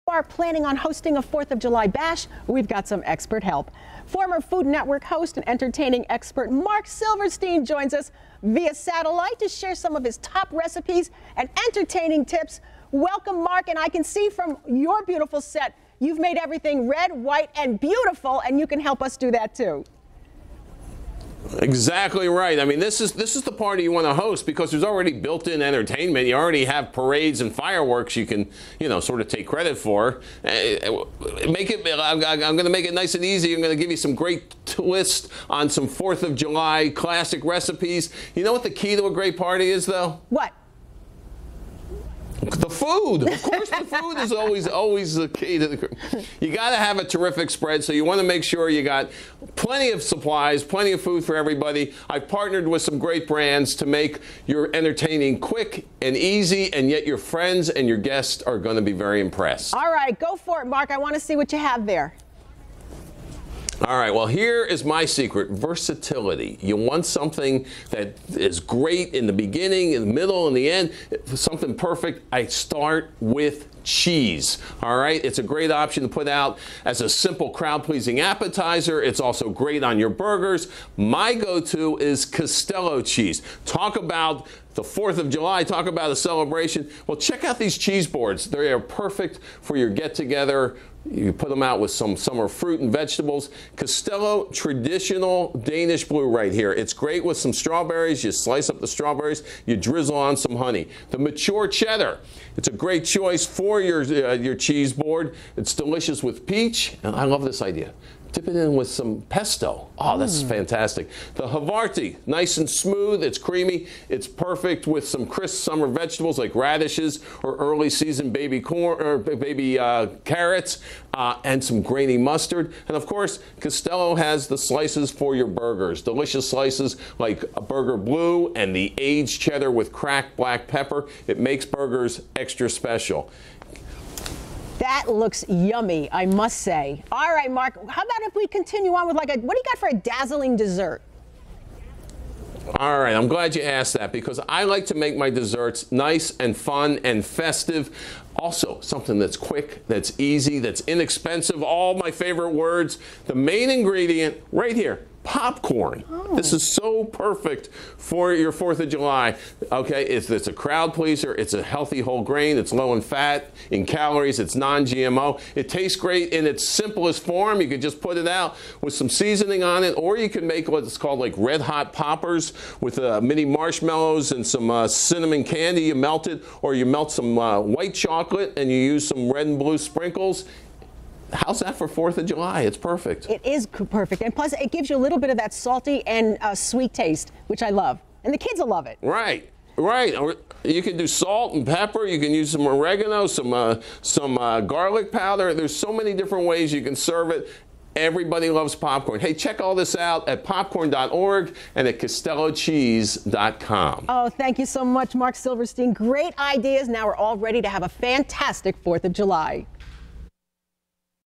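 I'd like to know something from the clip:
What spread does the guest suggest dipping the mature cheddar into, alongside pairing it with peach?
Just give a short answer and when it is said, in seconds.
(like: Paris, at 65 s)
pesto, at 109 s.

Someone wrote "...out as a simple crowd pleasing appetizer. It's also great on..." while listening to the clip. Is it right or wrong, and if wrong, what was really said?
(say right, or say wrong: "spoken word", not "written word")
right.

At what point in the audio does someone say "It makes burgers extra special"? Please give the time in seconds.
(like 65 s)
131 s.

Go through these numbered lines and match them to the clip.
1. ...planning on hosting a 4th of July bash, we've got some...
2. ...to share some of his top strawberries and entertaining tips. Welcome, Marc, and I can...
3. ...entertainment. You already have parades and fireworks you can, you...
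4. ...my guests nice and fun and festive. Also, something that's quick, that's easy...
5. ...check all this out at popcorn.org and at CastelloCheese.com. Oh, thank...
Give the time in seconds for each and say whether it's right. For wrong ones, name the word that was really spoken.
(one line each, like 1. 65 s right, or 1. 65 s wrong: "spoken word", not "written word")
1. 0 s right
2. 9 s wrong: "recipes", not "strawberries"
3. 25 s right
4. 145 s wrong: "desserts", not "guests"
5. 199 s right.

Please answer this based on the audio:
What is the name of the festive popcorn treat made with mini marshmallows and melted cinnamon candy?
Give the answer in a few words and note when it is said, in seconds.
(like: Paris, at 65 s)
red hot poppers, at 171 s.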